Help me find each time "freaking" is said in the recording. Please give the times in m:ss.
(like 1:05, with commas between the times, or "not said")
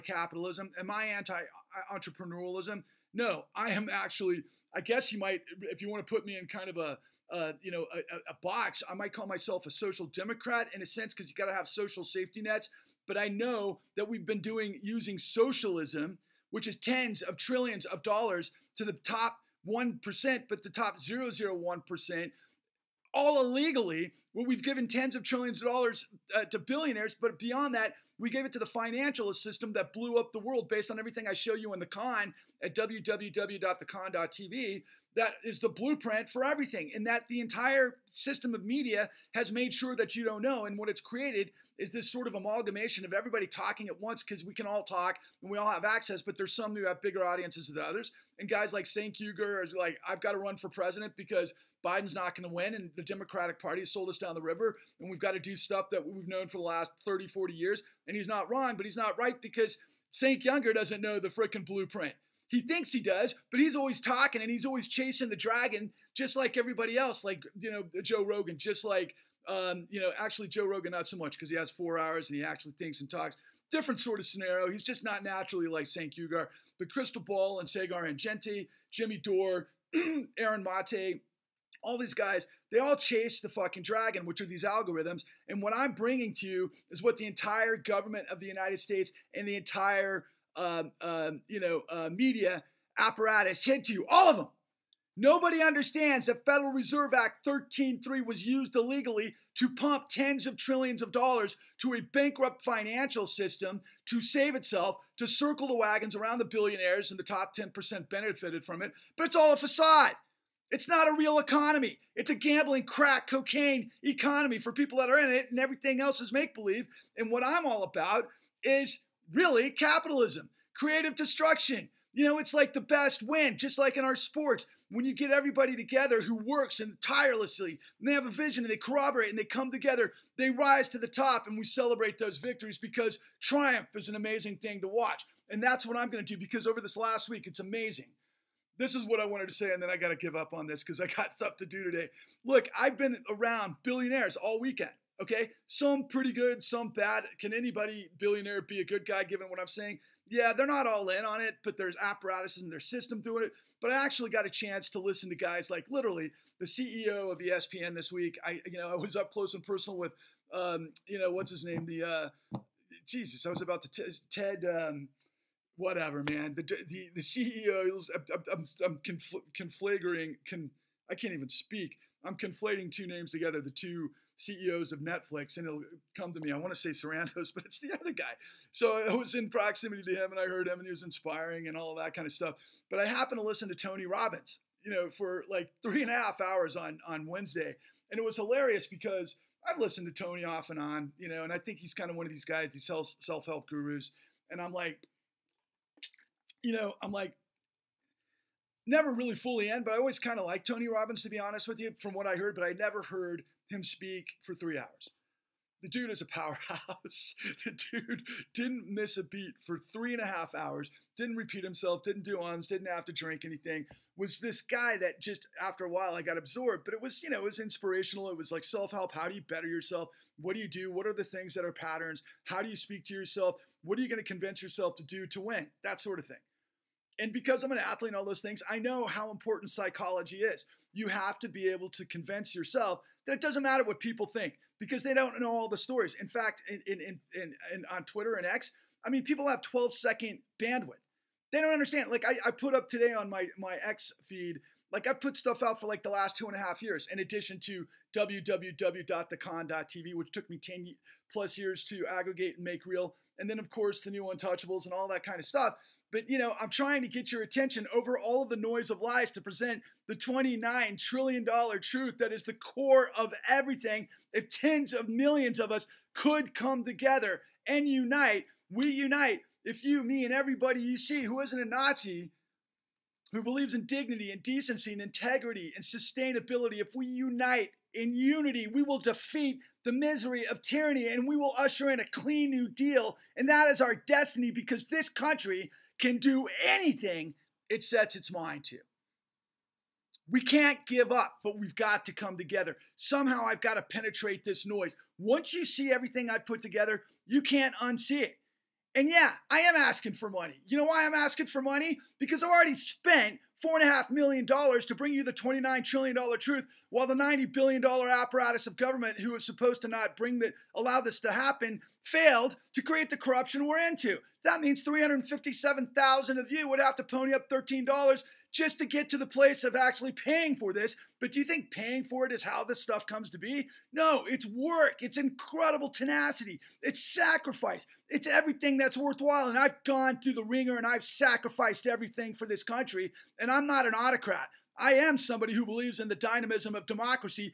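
1:01.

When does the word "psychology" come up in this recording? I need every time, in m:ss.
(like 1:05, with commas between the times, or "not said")
3:49.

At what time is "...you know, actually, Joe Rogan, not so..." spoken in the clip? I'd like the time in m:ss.
1:09.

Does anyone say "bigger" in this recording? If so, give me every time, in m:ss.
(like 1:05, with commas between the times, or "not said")
0:47.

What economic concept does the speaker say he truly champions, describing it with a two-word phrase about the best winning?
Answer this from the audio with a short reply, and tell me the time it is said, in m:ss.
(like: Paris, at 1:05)
creative destruction, at 2:00.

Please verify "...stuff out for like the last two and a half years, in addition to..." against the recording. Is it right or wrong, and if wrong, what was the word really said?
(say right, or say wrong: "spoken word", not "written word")
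right.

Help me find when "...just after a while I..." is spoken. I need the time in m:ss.
3:35.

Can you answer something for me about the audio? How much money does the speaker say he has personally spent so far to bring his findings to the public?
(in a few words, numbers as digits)
$4.5 million.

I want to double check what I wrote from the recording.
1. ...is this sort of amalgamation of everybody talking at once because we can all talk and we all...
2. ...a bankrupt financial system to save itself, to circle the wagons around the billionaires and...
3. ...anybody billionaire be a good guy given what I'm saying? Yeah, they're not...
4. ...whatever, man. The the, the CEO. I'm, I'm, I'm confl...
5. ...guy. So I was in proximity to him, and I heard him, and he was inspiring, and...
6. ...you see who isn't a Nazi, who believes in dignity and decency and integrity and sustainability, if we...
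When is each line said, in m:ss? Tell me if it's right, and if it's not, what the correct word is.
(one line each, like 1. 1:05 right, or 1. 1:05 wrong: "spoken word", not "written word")
1. 0:41 right
2. 1:41 right
3. 2:27 right
4. 2:45 right
5. 2:58 right
6. 4:30 right.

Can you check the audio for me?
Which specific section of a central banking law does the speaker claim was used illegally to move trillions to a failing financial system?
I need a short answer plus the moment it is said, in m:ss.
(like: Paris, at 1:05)
Federal Reserve Act 13.3, at 1:36.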